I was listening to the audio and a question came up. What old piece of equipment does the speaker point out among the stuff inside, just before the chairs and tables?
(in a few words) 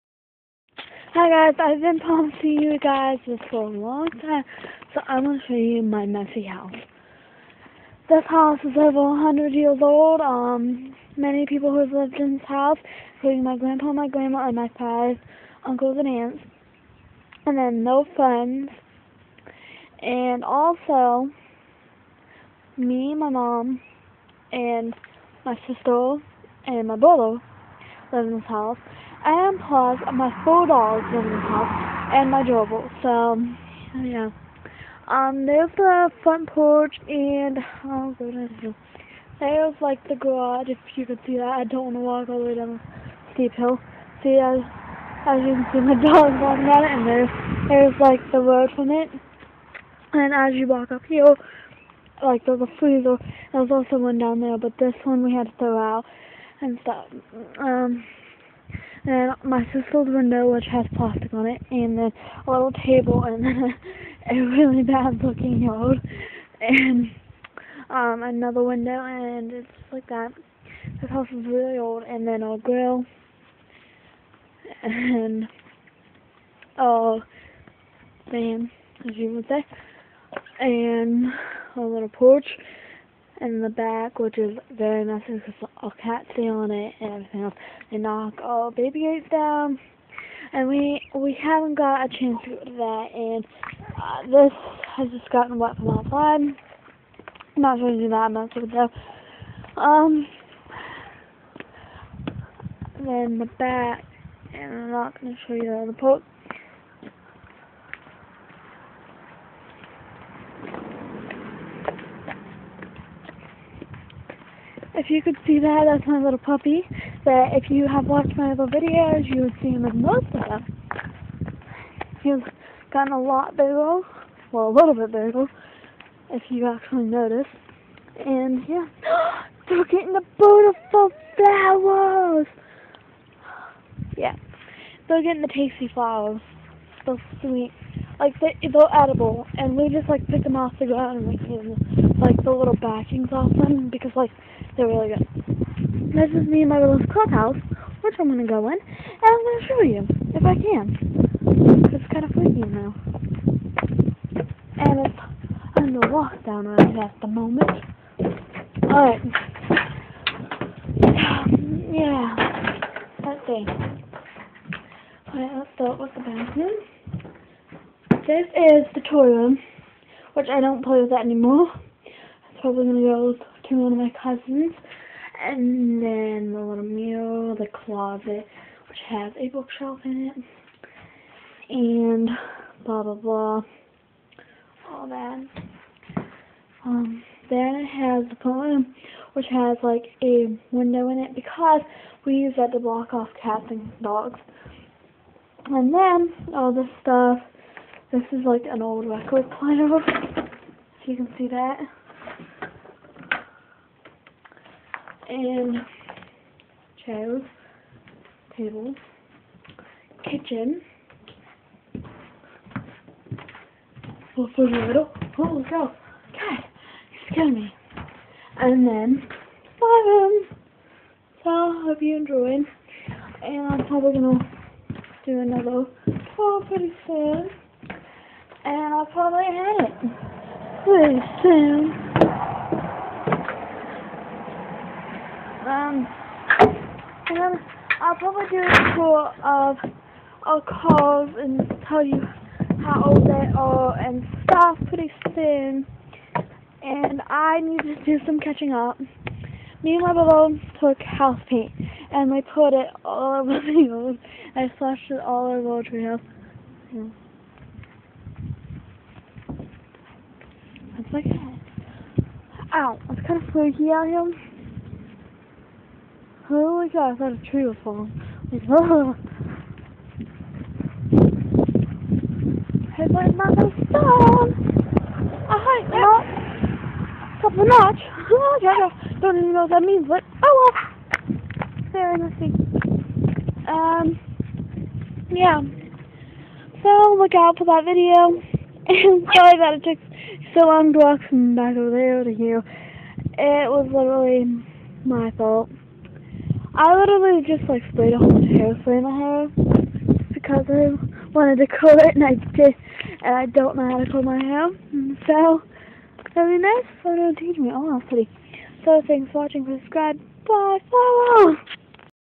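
record player.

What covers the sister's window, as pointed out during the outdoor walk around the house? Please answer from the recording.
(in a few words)
plastic.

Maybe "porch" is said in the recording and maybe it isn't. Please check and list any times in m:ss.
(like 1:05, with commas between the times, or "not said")
0:36, 1:22.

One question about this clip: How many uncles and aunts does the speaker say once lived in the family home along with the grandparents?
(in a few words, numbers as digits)
5.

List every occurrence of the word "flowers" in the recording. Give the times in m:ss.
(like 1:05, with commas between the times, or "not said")
2:11, 2:15.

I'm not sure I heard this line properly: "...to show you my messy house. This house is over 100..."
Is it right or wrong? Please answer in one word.
right.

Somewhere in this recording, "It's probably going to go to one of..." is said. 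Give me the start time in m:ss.
2:52.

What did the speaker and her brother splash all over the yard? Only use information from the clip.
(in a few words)
house paint.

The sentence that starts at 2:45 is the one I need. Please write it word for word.
Alright, let's start with the bathroom.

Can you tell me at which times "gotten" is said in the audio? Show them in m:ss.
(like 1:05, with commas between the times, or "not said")
1:35, 2:02.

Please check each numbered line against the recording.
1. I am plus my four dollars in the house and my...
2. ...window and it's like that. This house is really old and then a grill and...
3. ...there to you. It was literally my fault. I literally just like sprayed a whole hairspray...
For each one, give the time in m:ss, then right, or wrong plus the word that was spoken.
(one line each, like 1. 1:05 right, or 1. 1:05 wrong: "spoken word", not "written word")
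1. 0:29 right
2. 1:08 right
3. 4:51 right.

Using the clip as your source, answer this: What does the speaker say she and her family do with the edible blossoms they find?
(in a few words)
pick them off the ground.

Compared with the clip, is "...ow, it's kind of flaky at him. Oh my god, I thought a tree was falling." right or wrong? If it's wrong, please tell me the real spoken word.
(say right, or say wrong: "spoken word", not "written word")
right.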